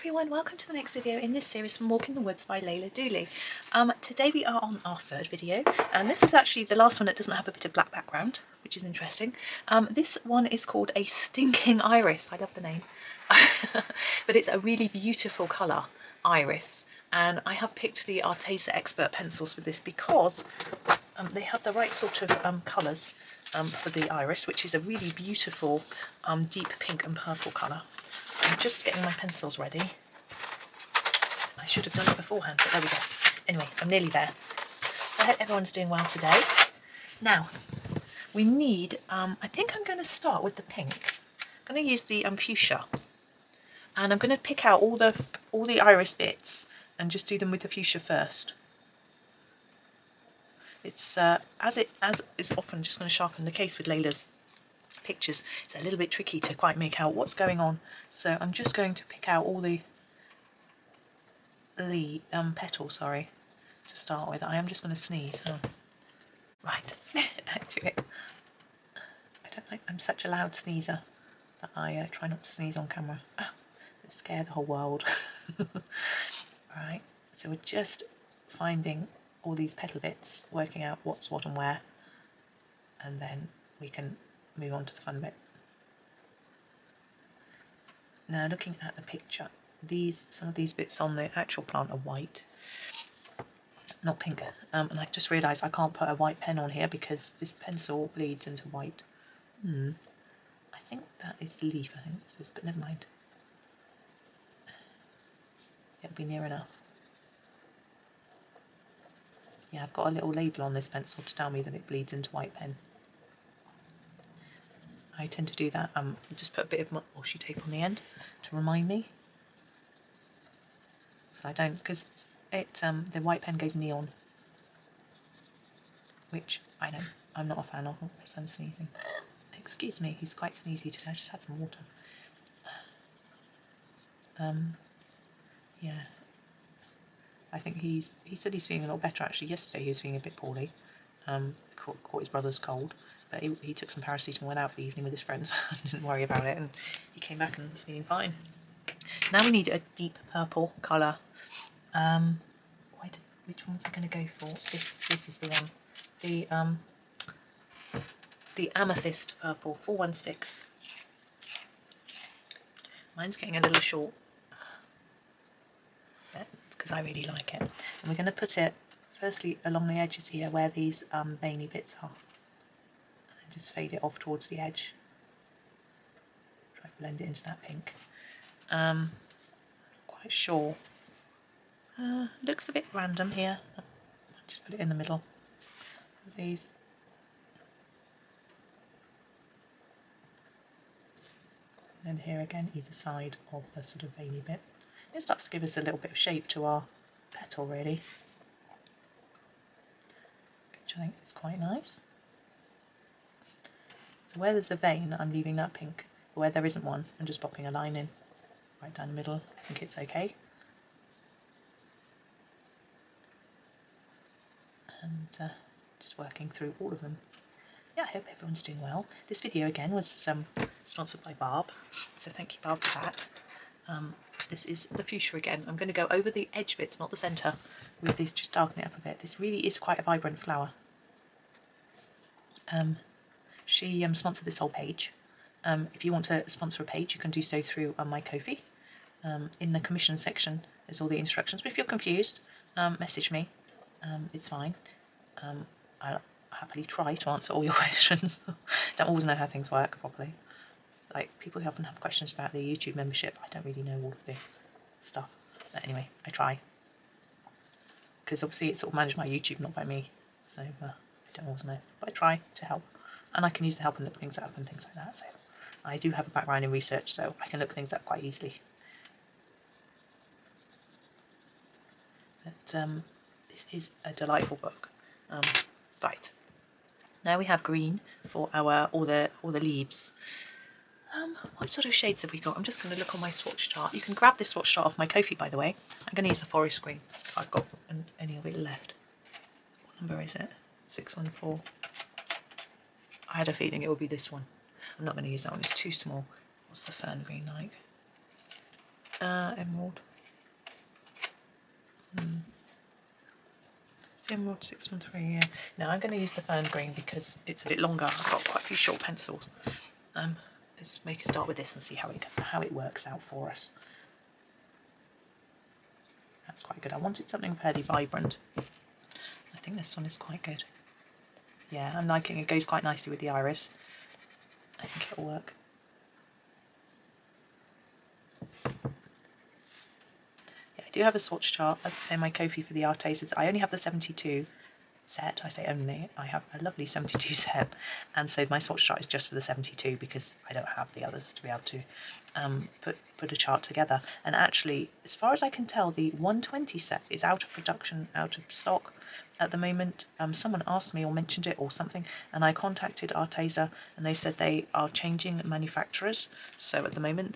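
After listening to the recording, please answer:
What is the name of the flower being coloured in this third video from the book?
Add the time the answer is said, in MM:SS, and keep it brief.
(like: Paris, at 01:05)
A Stinking Iris, at 00:10.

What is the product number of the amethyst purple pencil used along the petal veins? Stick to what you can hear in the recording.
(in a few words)
416.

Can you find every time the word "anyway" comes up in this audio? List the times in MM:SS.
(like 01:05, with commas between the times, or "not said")
00:33, 04:15.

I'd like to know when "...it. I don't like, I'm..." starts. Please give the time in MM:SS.
01:07.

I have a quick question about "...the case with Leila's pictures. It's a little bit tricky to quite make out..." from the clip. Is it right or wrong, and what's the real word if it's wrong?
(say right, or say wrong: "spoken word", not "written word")
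right.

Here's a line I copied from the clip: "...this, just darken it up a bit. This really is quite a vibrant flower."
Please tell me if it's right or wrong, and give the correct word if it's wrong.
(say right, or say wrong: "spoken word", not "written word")
right.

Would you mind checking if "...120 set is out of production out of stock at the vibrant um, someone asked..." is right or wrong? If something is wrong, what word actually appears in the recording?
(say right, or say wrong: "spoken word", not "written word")
wrong: "moment", not "vibrant".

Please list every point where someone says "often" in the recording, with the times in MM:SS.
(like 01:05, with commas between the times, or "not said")
00:52, 04:11.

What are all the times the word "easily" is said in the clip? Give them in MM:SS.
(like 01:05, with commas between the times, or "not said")
04:28.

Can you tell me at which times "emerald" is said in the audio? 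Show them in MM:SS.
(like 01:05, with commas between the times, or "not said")
04:59, 05:04.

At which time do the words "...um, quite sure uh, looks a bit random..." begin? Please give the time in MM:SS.
02:58.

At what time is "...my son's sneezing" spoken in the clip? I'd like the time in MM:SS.
02:08.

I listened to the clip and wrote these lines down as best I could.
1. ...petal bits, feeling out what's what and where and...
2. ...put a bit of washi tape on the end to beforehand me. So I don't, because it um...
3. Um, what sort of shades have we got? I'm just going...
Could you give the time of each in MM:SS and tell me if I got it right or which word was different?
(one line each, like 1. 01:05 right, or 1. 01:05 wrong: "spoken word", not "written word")
1. 01:19 wrong: "working", not "feeling"
2. 01:56 wrong: "remind", not "beforehand"
3. 04:41 right.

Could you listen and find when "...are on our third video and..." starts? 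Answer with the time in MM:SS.
00:04.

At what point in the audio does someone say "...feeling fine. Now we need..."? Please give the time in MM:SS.
02:27.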